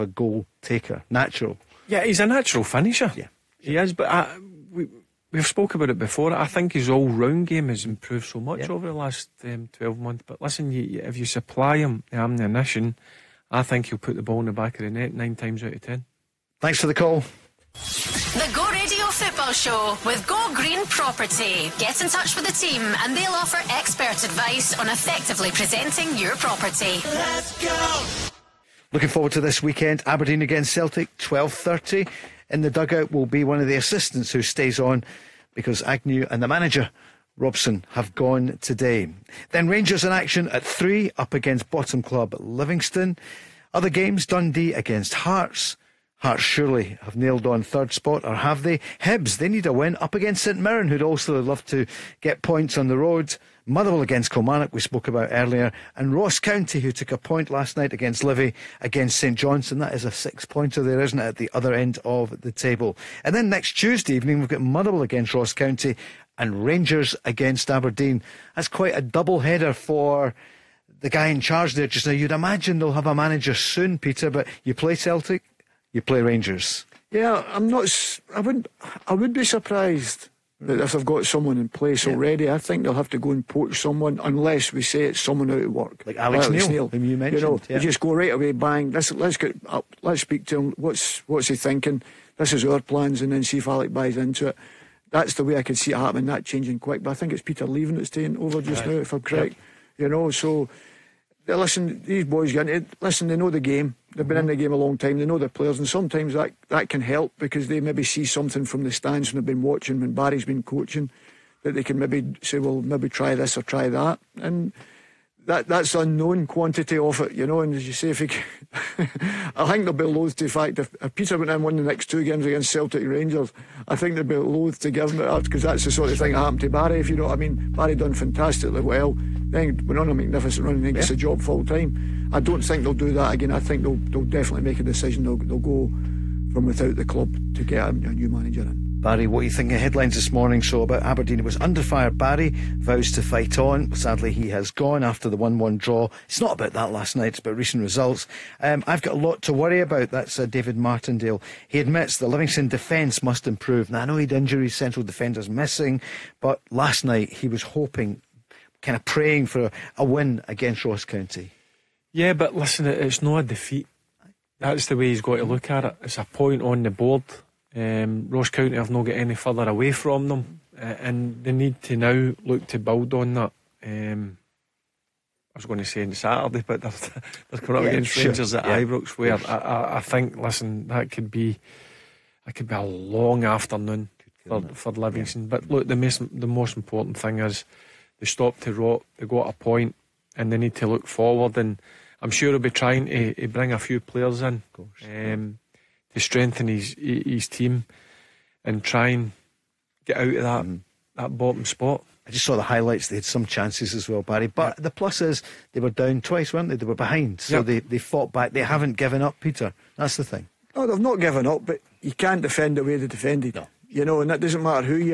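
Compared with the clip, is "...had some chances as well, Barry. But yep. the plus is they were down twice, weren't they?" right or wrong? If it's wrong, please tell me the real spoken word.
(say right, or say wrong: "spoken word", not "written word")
right.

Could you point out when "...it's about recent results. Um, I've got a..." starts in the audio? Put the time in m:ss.
2:27.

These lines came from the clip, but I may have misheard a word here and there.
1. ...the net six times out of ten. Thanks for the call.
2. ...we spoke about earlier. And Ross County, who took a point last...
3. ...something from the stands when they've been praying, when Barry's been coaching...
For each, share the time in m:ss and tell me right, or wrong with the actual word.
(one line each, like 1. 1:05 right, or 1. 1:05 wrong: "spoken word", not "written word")
1. 0:14 wrong: "nine", not "six"
2. 0:54 right
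3. 1:48 wrong: "watching", not "praying".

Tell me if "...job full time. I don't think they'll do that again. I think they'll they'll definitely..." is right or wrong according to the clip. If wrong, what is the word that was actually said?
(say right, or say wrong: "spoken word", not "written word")
right.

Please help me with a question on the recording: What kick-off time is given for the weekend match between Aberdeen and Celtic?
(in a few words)
12.30.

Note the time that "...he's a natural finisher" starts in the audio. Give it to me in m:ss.
0:02.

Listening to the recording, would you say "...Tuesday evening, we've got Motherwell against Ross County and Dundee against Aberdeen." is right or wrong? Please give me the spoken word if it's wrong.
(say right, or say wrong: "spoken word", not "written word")
wrong: "Rangers", not "Dundee".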